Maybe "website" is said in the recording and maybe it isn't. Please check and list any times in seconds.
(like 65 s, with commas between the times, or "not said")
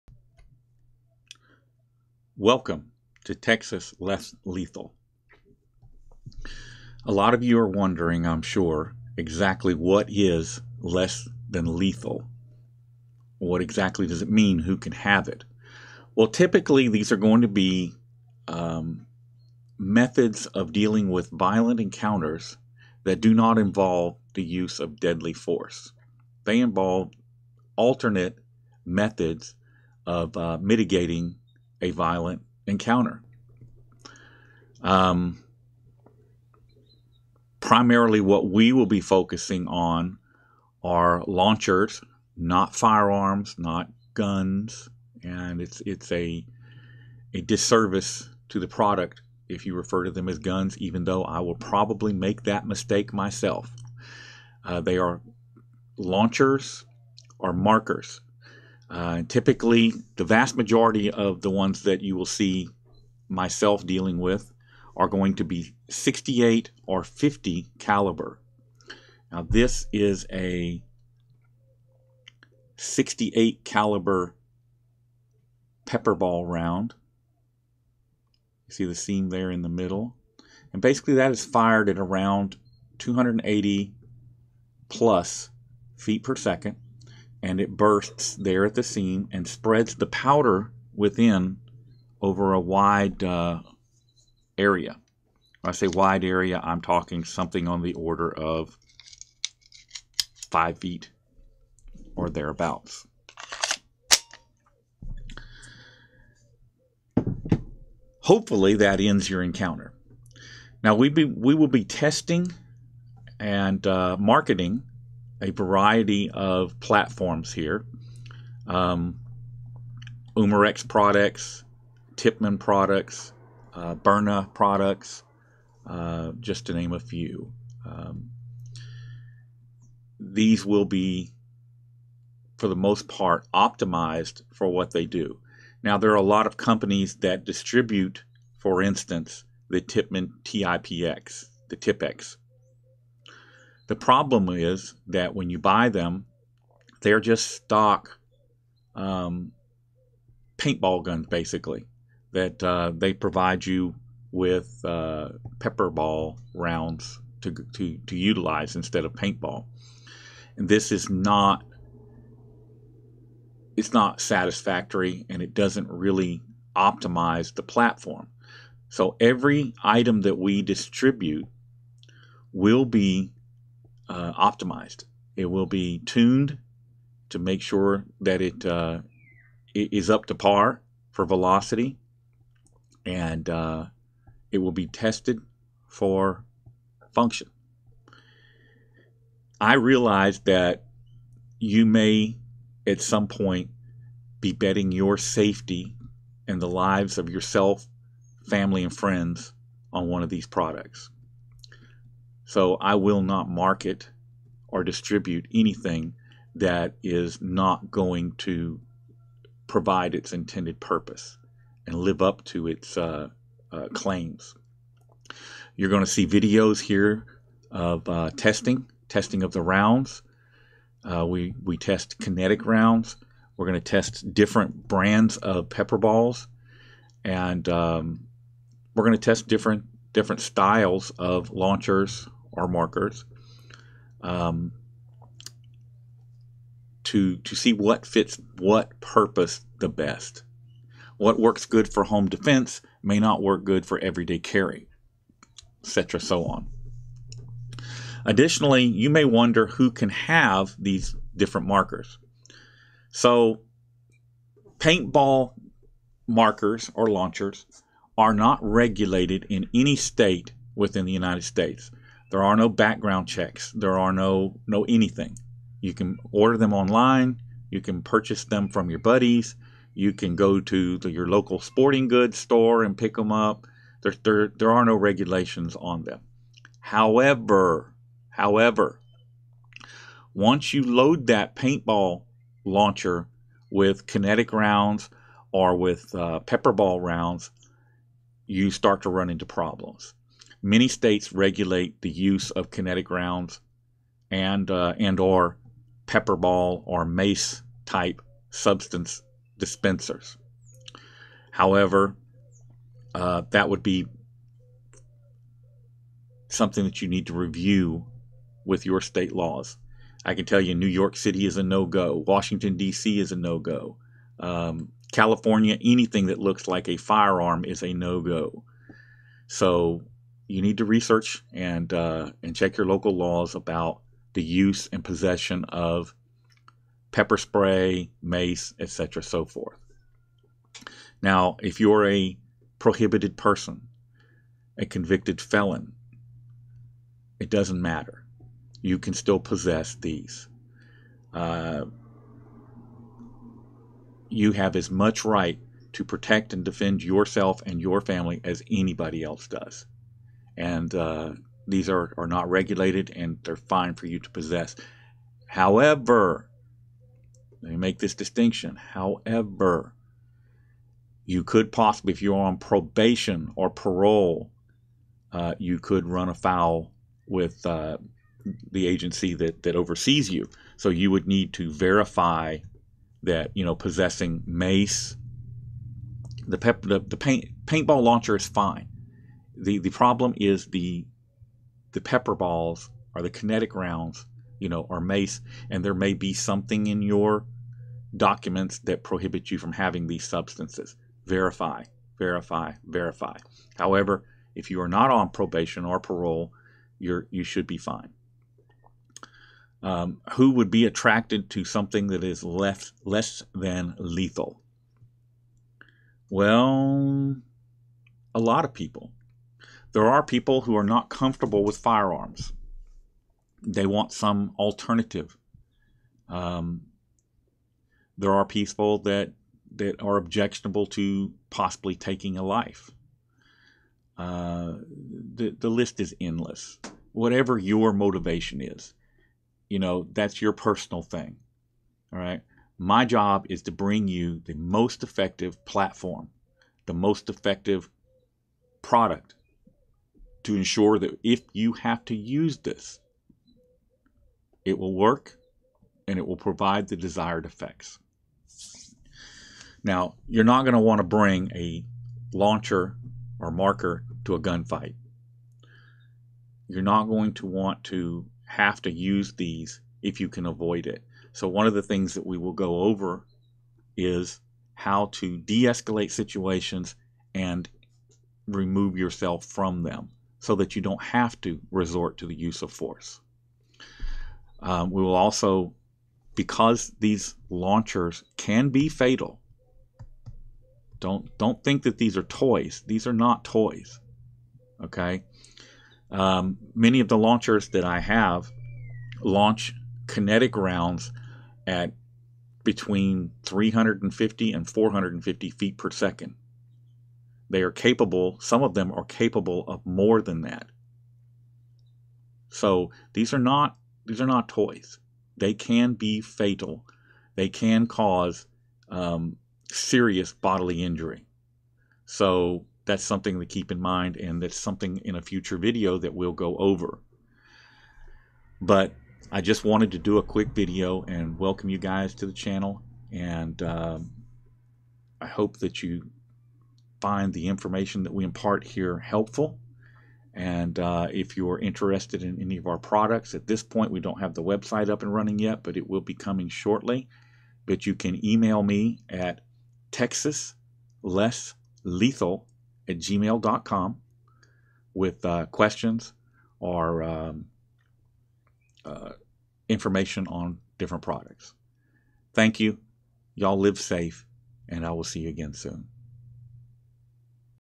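534 s.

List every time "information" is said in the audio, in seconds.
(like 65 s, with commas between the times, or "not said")
527 s, 549 s.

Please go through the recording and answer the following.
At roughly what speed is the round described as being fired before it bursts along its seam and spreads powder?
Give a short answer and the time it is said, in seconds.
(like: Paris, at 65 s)
280 feet per second, at 82 s.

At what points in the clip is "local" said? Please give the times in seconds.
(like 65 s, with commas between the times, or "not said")
271 s, 322 s.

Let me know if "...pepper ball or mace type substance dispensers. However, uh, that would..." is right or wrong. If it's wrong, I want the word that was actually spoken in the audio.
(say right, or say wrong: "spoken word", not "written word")
right.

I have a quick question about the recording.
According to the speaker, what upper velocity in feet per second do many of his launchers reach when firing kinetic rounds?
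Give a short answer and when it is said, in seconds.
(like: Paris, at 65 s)
450, at 494 s.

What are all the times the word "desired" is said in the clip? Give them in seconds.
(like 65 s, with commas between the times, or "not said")
446 s.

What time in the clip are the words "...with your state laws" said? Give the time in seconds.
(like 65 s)
308 s.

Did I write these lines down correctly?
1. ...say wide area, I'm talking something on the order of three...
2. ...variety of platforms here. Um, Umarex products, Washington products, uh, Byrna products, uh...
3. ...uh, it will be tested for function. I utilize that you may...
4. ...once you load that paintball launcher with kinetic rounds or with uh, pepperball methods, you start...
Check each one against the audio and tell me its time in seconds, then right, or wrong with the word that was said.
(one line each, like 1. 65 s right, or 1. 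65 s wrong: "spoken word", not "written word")
1. 95 s wrong: "five", not "three"
2. 115 s wrong: "Tippmann", not "Washington"
3. 183 s wrong: "realize", not "utilize"
4. 280 s wrong: "rounds", not "methods".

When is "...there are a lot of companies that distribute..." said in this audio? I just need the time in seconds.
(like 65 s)
135 s.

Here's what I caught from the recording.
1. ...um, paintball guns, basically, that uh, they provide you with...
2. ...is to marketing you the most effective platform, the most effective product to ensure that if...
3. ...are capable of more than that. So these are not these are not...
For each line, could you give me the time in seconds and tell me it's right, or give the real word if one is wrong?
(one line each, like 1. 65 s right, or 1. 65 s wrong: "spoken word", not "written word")
1. 148 s right
2. 433 s wrong: "bring", not "marketing"
3. 498 s right.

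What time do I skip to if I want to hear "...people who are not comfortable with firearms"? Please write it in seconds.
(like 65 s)
410 s.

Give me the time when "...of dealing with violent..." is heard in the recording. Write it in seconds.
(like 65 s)
20 s.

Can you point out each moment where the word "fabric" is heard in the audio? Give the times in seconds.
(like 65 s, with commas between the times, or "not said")
not said.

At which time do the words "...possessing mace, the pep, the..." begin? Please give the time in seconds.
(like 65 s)
373 s.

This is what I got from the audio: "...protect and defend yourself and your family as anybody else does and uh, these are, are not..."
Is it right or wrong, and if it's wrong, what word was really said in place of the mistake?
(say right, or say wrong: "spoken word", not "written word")
right.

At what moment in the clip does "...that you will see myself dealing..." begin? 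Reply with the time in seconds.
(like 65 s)
61 s.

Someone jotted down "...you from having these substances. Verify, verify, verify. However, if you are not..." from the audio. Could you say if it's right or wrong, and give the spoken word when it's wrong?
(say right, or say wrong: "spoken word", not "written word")
right.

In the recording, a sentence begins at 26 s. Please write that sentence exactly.
They involve alternate methods of uh, mitigating a violent encounter.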